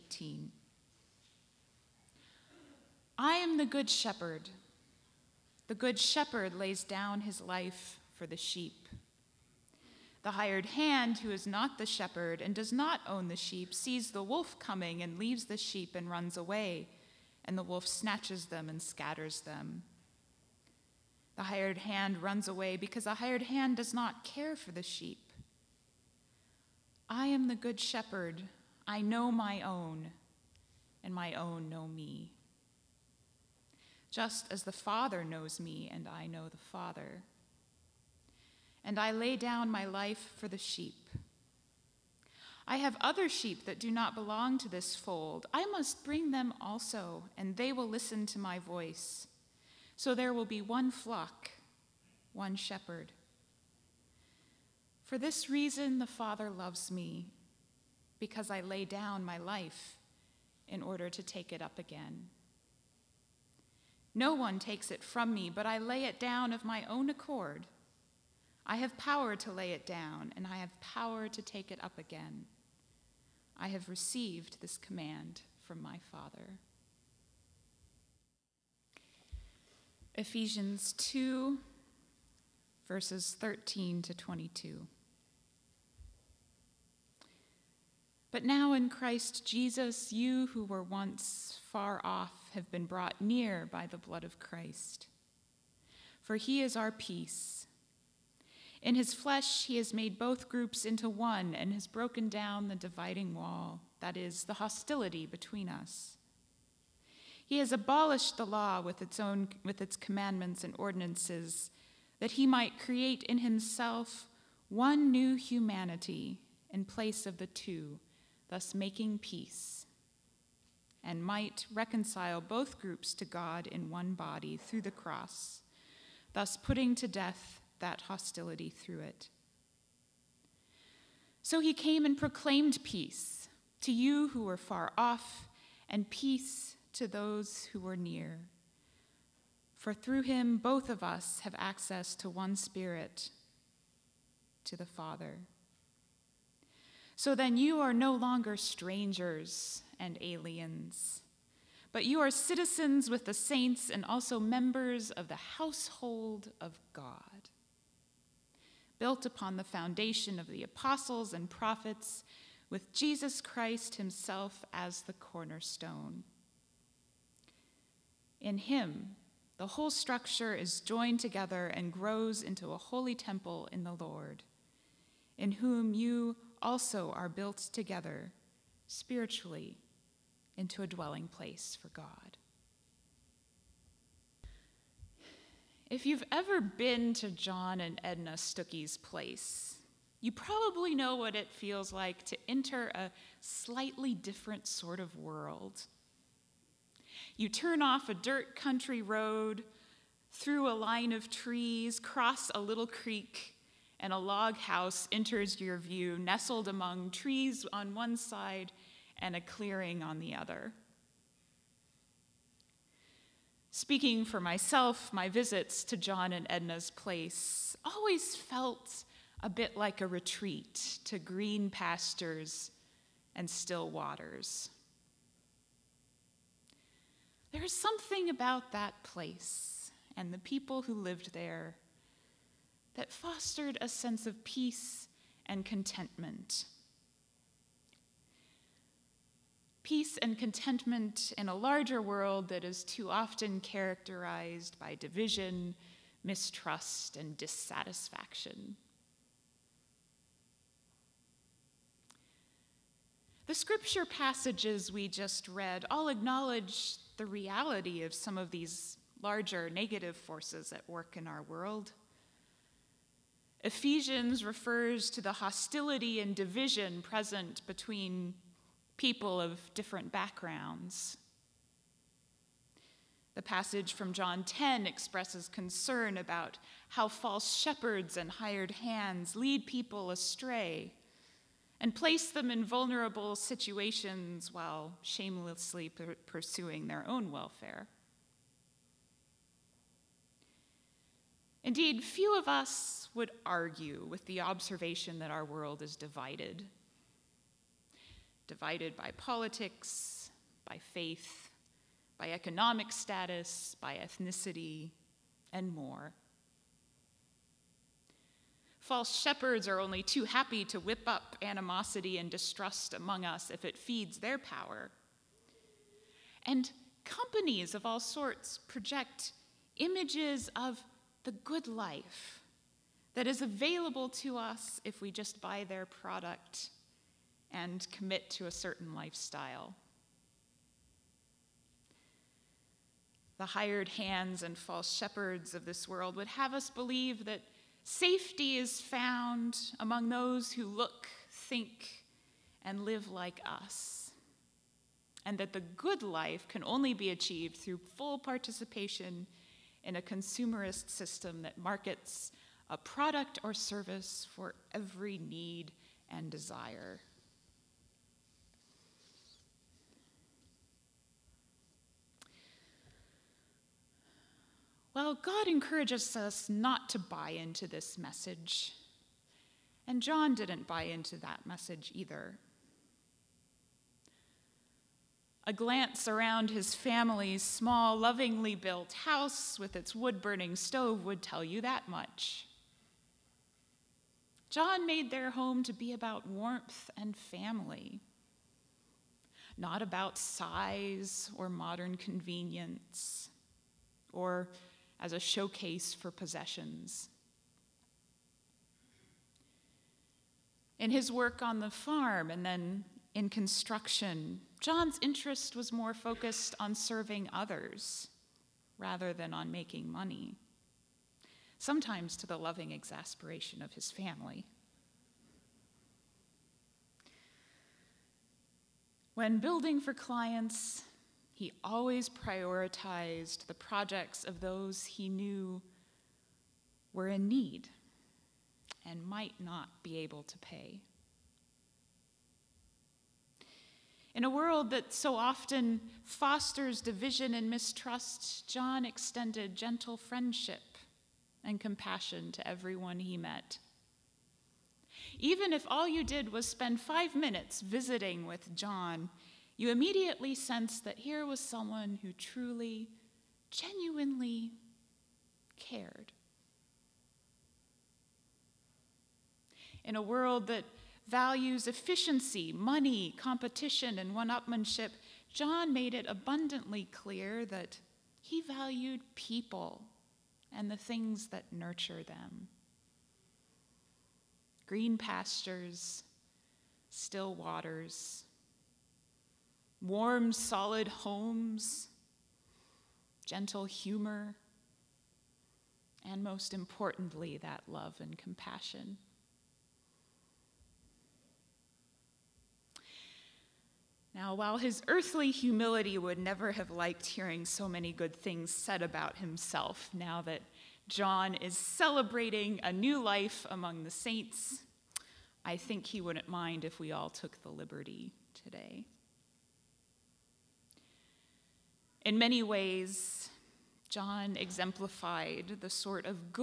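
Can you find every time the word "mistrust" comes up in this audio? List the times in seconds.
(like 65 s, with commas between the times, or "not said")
246 s, 437 s.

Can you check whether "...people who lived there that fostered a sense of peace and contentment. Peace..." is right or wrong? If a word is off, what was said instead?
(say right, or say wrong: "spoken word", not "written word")
right.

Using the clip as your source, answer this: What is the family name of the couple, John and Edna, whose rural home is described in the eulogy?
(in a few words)
Stucky.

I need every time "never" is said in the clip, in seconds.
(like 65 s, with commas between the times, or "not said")
496 s.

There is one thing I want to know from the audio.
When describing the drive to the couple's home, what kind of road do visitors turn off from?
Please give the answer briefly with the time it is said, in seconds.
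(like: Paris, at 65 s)
dirt country road, at 198 s.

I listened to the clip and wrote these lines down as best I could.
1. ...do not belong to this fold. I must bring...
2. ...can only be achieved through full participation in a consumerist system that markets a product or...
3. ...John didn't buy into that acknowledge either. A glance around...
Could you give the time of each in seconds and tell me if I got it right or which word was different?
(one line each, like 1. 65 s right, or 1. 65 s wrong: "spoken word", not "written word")
1. 43 s right
2. 346 s right
3. 370 s wrong: "message", not "acknowledge".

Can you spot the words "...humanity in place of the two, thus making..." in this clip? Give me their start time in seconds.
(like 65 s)
115 s.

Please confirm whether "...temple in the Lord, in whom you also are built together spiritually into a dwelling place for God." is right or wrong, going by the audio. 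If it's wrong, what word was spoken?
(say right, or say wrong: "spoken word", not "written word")
right.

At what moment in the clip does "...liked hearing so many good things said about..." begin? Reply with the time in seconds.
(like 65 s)
496 s.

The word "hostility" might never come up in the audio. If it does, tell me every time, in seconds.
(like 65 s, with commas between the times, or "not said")
104 s, 128 s, 265 s.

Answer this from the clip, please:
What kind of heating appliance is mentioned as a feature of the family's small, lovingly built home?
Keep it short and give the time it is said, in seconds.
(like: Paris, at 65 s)
wood burning stove, at 379 s.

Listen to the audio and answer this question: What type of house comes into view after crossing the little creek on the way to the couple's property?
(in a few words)
log house.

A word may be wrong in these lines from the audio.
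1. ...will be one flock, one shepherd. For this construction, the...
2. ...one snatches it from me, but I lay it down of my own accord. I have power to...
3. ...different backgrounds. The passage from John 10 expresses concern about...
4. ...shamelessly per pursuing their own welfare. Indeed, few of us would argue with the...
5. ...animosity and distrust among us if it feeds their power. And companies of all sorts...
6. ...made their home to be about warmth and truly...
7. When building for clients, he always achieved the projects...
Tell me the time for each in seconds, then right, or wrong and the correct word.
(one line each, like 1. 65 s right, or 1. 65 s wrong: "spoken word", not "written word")
1. 50 s wrong: "reason", not "construction"
2. 64 s wrong: "takes", not "snatches"
3. 269 s right
4. 285 s right
5. 311 s right
6. 384 s wrong: "family", not "truly"
7. 419 s wrong: "prioritized", not "achieved".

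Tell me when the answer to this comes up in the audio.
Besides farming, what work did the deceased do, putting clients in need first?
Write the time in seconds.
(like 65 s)
403 s.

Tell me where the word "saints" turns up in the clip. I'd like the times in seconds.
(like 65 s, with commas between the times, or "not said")
153 s, 503 s.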